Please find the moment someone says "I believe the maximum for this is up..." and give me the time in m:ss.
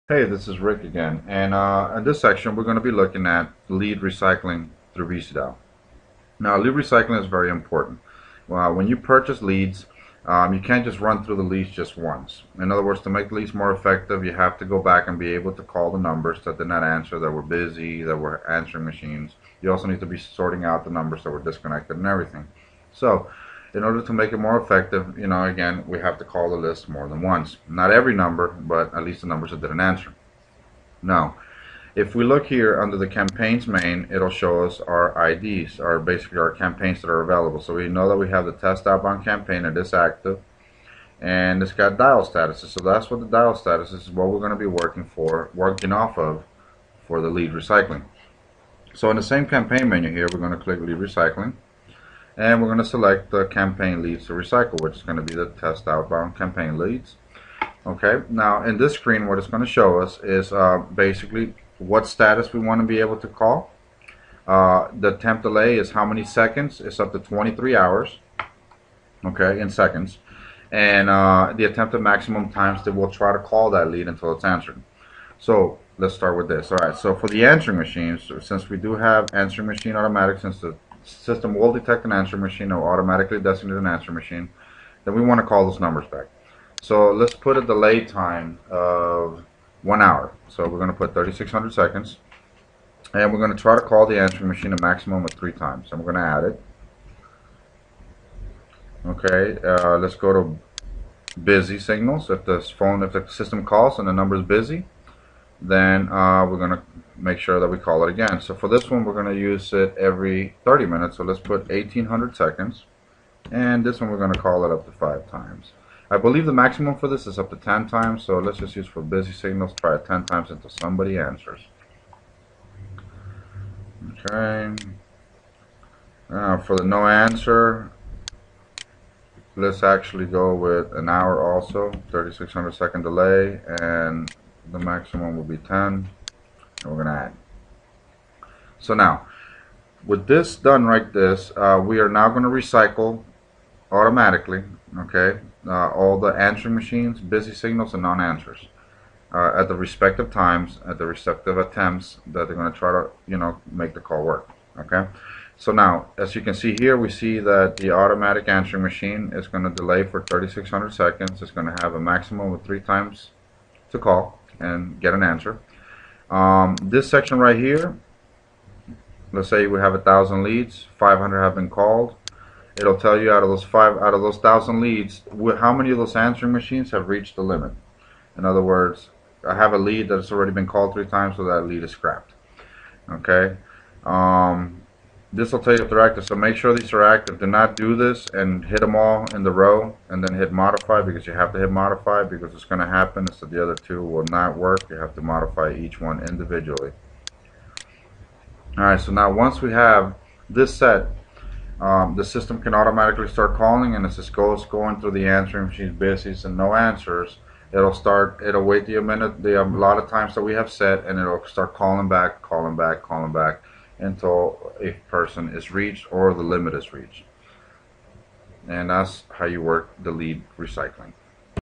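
1:56.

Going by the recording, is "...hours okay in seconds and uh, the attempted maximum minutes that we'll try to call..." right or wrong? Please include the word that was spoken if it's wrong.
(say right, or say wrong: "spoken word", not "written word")
wrong: "times", not "minutes".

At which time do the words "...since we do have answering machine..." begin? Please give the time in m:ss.
1:18.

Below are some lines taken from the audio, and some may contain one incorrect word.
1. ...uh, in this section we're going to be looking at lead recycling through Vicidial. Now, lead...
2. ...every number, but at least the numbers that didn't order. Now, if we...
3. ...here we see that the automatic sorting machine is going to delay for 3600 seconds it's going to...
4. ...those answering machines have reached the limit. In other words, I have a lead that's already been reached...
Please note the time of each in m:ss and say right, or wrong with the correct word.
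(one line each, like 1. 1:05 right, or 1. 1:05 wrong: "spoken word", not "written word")
1. 0:01 right
2. 0:27 wrong: "answer", not "order"
3. 2:36 wrong: "answering", not "sorting"
4. 2:55 wrong: "called", not "reached".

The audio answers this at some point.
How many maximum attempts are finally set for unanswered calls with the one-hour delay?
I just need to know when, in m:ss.
2:14.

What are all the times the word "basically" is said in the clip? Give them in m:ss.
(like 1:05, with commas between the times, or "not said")
0:35, 1:00.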